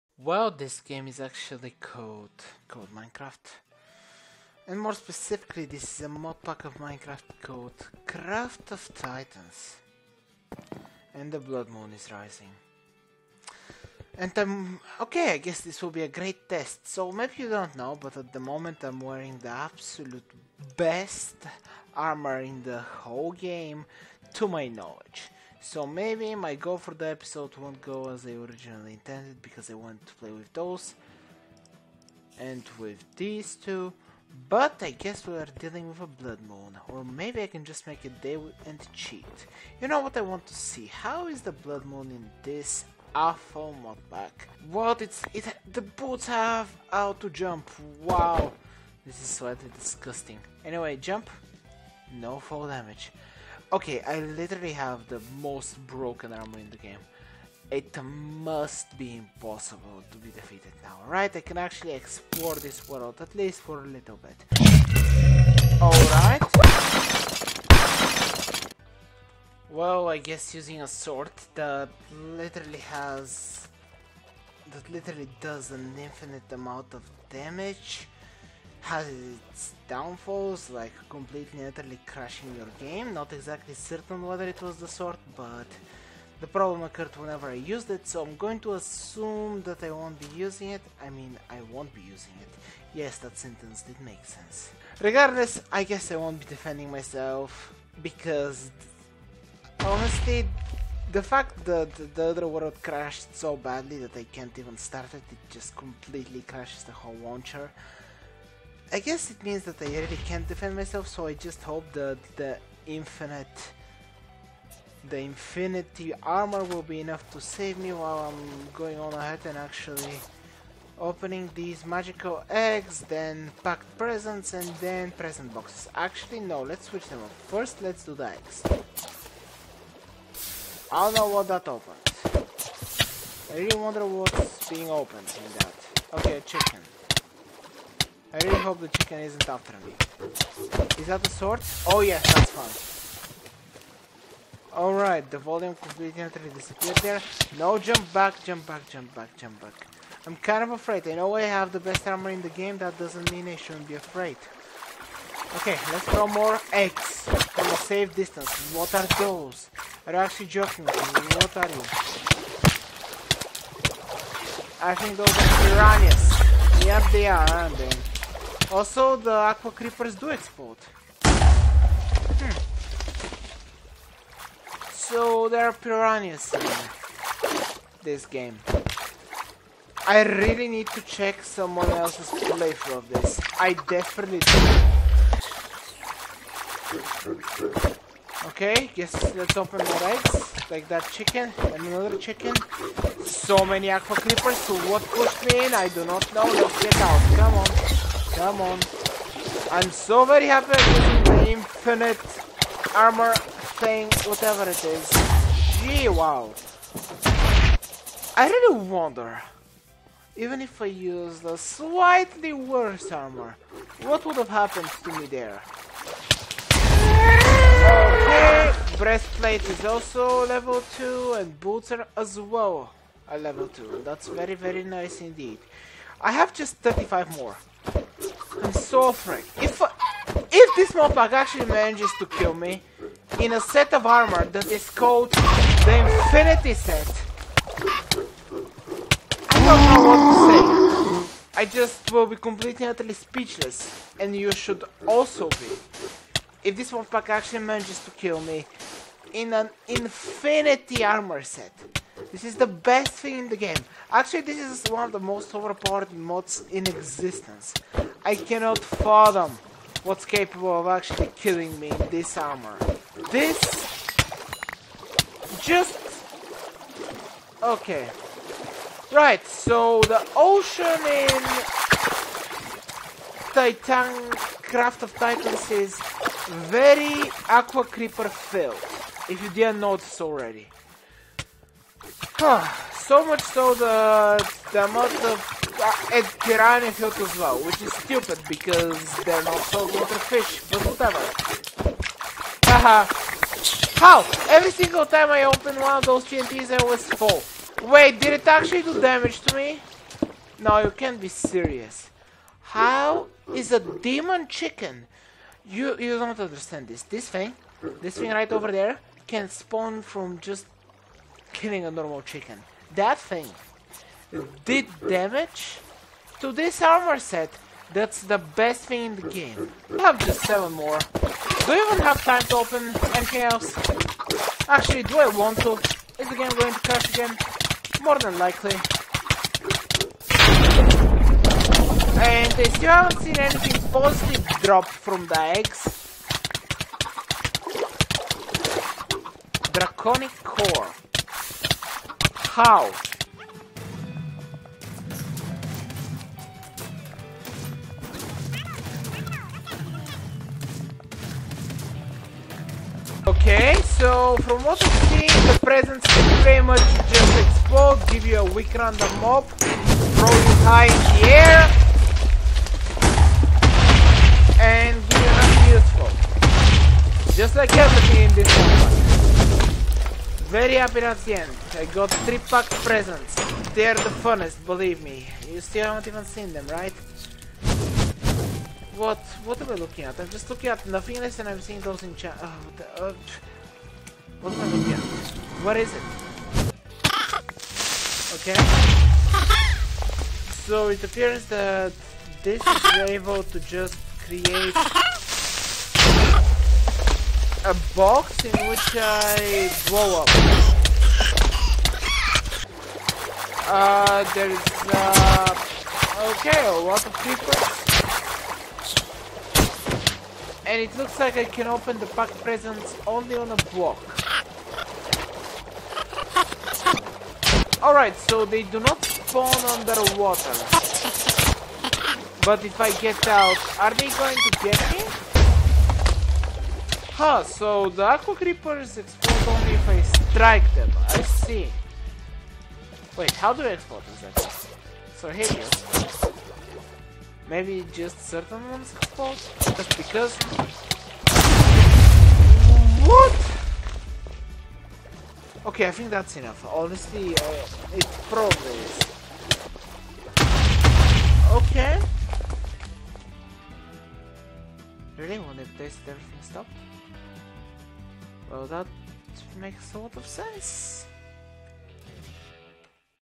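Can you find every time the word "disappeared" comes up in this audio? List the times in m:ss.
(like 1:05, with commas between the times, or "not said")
2:26.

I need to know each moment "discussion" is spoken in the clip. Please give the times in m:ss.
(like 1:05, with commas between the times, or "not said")
not said.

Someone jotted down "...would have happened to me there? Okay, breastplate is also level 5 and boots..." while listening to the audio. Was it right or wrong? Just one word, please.
wrong.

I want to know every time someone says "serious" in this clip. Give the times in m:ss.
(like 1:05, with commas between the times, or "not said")
5:01.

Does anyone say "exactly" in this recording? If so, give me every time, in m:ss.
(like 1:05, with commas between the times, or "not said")
1:23, 7:14.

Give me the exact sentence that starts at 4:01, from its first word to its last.
I just will be completely utterly speechless, and you should also be.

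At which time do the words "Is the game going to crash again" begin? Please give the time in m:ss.
5:26.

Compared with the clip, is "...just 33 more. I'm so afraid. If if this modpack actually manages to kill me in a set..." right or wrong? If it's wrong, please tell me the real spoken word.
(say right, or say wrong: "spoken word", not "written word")
wrong: "35", not "33".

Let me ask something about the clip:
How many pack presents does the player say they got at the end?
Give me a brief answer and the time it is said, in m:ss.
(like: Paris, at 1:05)
3, at 6:12.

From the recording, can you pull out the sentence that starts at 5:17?
That's the best thing in the game.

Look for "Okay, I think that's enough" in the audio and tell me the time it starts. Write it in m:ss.
7:25.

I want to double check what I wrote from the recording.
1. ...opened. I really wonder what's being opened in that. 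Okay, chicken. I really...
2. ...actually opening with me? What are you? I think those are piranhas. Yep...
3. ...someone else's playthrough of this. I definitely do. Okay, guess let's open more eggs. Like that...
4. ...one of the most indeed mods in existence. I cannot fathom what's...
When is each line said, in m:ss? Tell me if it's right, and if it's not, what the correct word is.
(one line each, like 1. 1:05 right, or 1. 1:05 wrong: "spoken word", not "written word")
1. 2:11 right
2. 2:40 wrong: "joking", not "opening"
3. 3:01 right
4. 4:14 wrong: "overpowered", not "indeed".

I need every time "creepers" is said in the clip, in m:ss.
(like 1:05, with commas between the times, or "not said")
2:49, 3:14, 4:37, 7:08.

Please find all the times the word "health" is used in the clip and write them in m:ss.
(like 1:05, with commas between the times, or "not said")
4:46.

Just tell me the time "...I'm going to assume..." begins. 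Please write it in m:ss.
1:28.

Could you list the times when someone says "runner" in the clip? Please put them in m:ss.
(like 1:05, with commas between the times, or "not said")
not said.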